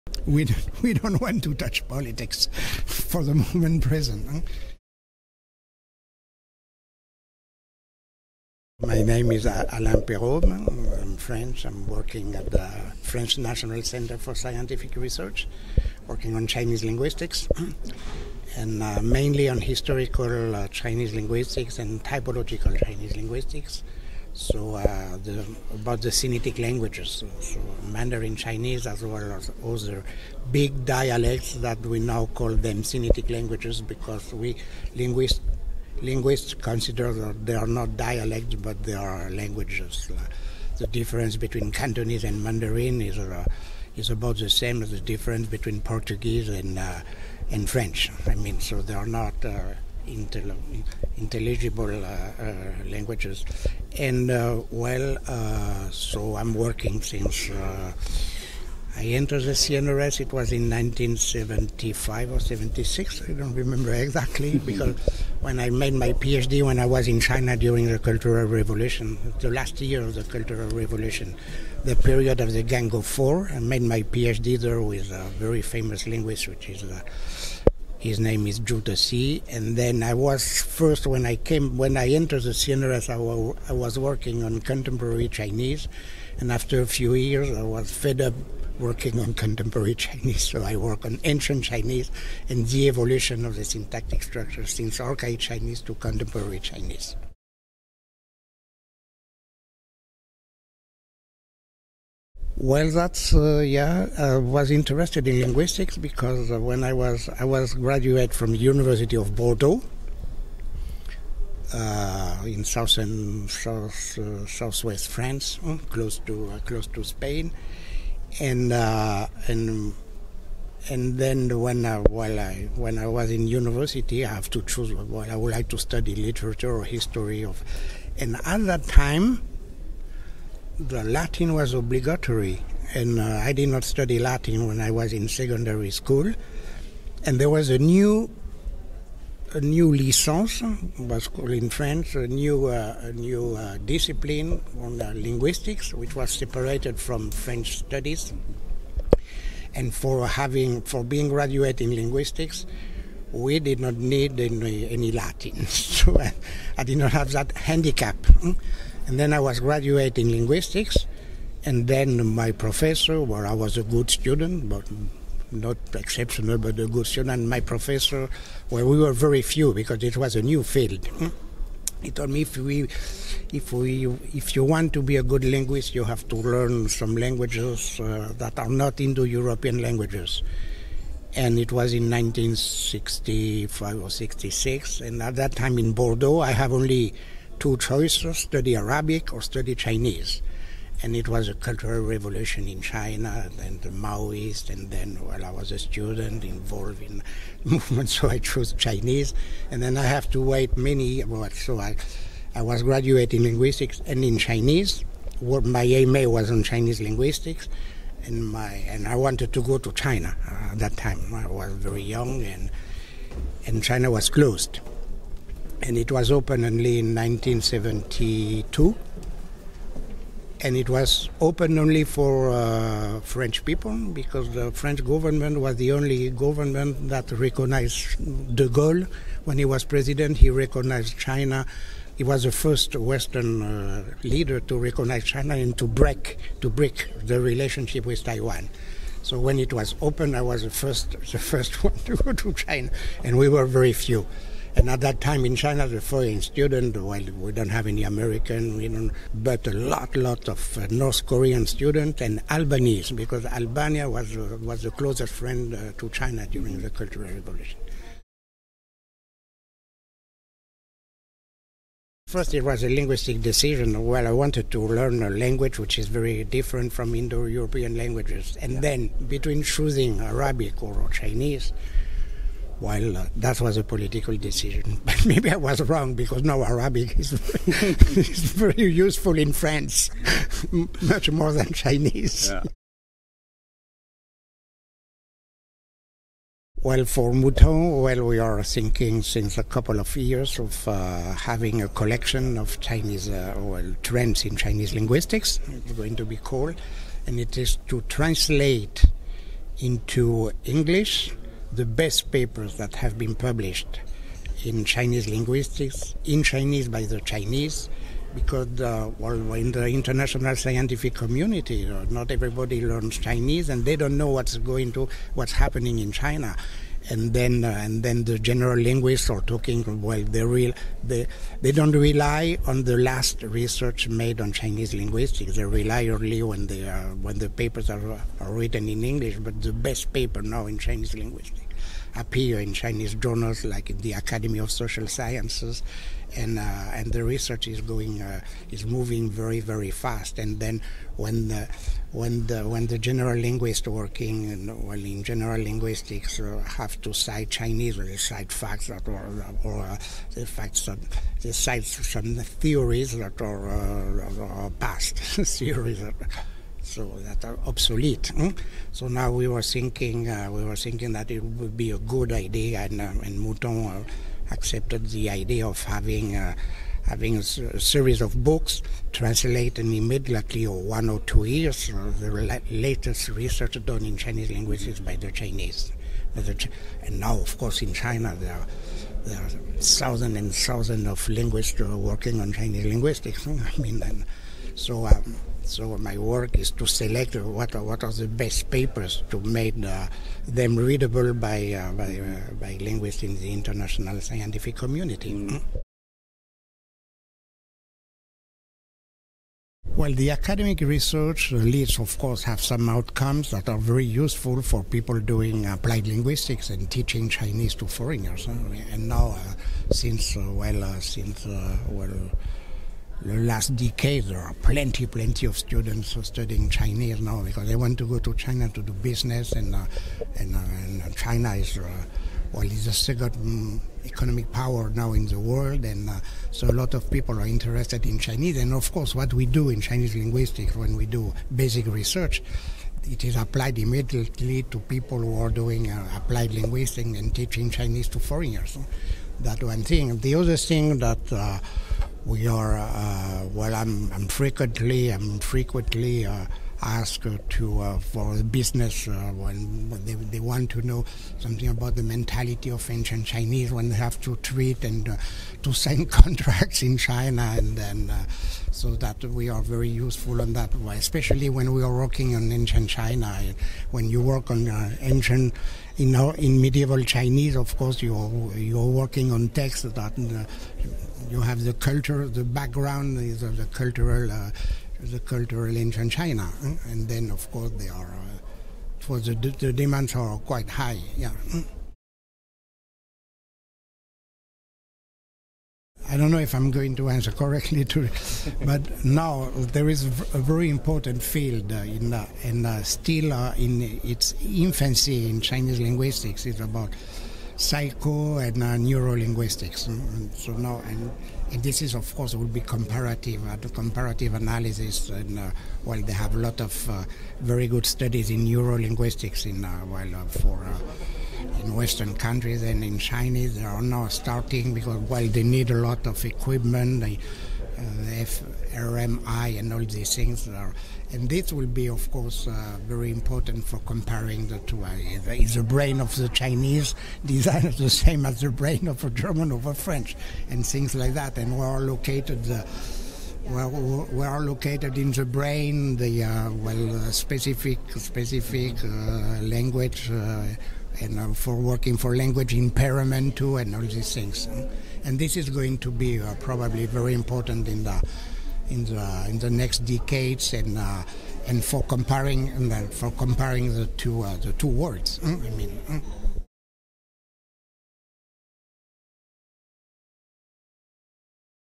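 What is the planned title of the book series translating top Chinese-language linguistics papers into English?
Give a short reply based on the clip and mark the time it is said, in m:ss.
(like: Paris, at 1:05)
Trends in Chinese Linguistics, at 4:54.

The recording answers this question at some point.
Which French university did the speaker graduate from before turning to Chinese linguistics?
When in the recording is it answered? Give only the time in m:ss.
1:48.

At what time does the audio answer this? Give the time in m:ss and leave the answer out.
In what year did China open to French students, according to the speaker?
3:37.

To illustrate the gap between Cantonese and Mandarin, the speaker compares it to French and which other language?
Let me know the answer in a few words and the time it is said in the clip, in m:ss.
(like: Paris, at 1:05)
Portuguese, at 0:45.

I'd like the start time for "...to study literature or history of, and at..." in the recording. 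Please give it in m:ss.
2:05.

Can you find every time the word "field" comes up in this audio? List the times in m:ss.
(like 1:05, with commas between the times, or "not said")
2:50, 8:11.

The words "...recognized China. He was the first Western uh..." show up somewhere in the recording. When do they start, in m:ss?
3:50.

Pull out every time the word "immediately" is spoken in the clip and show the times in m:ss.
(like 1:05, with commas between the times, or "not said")
6:09, 7:13.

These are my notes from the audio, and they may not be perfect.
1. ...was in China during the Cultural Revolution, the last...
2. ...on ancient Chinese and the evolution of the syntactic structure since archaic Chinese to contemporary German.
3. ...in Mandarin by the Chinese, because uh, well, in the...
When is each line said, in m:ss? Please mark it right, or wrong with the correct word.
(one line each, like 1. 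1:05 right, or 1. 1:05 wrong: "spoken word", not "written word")
1. 1:06 right
2. 1:31 wrong: "Chinese", not "German"
3. 5:06 wrong: "Chinese", not "Mandarin".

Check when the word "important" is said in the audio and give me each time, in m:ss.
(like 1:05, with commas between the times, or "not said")
8:10, 8:43, 9:07.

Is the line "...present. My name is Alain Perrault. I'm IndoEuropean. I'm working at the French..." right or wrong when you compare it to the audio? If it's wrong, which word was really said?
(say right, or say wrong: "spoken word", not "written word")
wrong: "French", not "IndoEuropean".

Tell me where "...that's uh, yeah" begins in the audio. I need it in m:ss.
1:42.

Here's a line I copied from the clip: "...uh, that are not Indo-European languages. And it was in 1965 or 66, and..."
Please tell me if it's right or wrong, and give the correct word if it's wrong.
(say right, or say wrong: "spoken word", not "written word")
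right.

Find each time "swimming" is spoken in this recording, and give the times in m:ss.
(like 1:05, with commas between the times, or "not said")
not said.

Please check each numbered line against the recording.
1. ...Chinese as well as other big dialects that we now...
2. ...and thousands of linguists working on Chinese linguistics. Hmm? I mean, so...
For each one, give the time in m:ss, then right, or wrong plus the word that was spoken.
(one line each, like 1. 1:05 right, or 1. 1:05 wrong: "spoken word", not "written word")
1. 0:28 right
2. 6:20 right.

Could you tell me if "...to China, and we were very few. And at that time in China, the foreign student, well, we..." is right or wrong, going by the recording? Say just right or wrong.
right.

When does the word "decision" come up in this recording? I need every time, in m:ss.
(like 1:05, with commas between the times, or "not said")
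4:23, 4:34.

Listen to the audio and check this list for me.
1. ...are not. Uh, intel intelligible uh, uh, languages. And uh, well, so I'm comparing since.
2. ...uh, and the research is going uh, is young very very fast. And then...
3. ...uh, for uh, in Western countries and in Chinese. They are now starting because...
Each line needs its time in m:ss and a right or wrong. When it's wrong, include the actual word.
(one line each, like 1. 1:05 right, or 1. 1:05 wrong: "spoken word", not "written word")
1. 0:48 wrong: "working", not "comparing"
2. 5:36 wrong: "moving", not "young"
3. 8:30 right.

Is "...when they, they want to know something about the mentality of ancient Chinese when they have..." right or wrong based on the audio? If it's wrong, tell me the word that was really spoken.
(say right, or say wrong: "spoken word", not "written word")
right.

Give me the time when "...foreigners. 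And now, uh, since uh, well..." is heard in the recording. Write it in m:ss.
6:47.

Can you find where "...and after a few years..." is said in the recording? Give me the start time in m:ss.
1:26.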